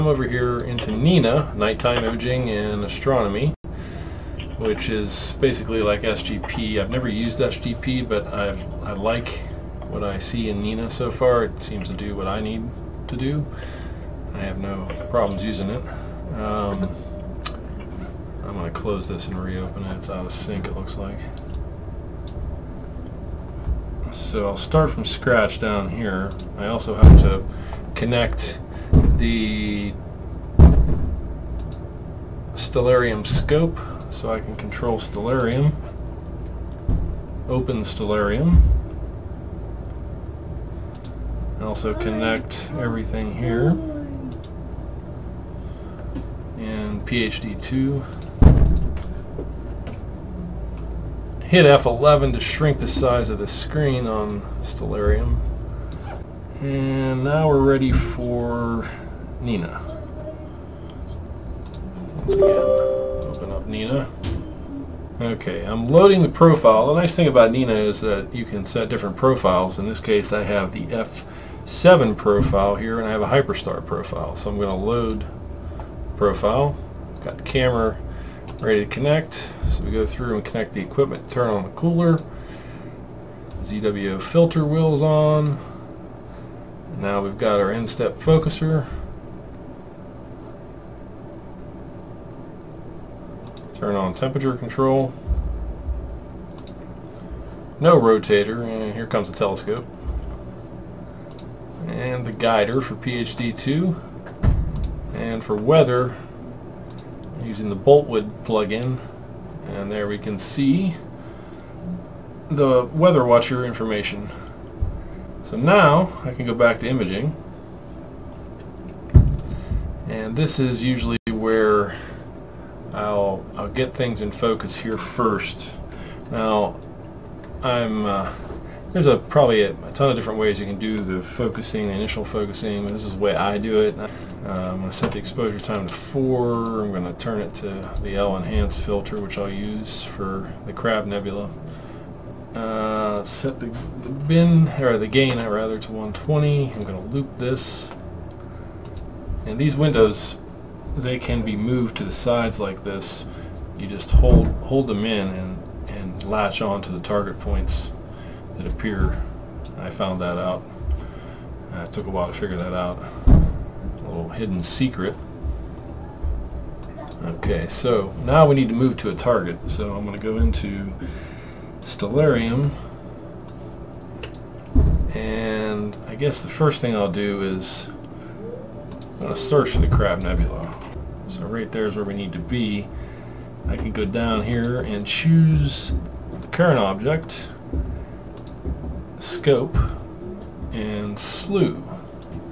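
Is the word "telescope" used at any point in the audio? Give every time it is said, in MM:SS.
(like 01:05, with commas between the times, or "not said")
01:39.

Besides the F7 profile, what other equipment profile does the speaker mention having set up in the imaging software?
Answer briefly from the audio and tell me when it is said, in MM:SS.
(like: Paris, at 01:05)
Hyperstar, at 01:13.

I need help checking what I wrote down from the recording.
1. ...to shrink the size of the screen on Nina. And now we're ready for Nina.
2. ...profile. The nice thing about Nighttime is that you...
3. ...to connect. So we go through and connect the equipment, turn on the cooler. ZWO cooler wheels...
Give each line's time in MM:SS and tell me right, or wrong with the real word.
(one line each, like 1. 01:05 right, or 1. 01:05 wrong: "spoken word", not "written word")
1. 00:52 wrong: "Stellarium", not "Nina"
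2. 01:06 wrong: "Nina", not "Nighttime"
3. 01:18 wrong: "filter", not "cooler".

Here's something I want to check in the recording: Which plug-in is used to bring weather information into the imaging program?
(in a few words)
Boltwood.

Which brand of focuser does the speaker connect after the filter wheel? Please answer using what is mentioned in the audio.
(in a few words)
nStep.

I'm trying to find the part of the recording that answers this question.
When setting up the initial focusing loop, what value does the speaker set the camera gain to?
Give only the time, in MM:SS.
02:25.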